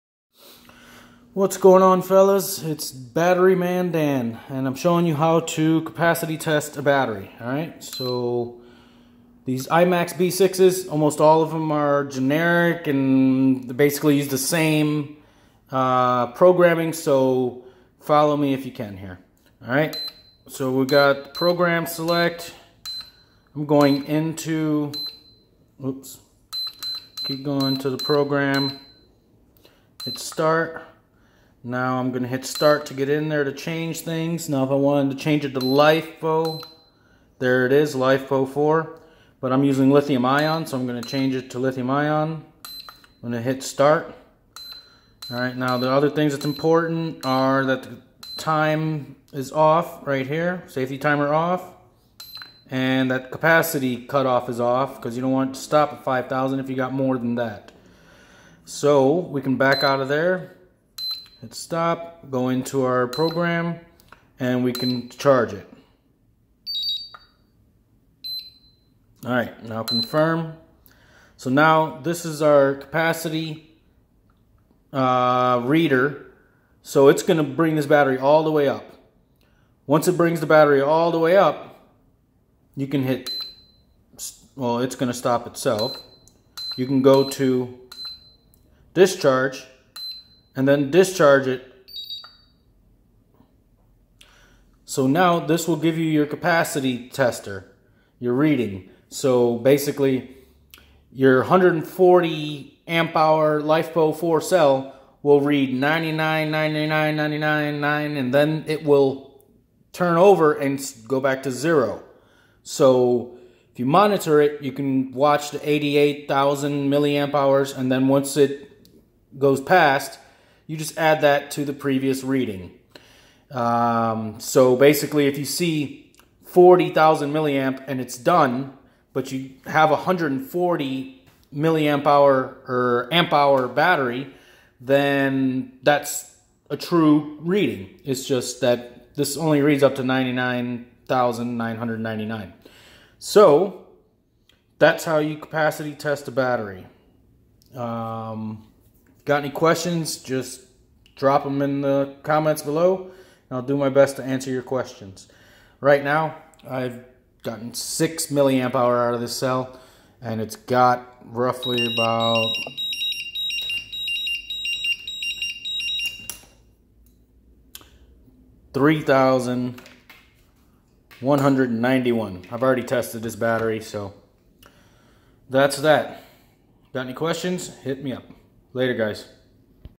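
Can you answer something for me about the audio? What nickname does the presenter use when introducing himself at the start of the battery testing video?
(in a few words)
Battery Man Dan.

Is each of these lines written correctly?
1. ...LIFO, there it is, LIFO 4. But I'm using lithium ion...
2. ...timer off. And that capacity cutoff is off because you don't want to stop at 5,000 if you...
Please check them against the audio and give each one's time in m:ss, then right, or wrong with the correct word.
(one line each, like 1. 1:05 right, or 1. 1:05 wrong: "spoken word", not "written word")
1. 0:35 right
2. 0:50 right.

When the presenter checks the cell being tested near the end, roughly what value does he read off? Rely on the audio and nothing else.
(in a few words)
3,191.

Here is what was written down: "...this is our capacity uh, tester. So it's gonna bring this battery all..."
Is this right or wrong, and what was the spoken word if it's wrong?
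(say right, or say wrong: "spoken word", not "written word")
wrong: "reader", not "tester".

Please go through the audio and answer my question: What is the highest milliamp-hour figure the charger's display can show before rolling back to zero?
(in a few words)
99,999.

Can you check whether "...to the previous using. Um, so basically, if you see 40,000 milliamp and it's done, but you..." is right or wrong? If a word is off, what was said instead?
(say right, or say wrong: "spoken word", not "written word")
wrong: "reading", not "using".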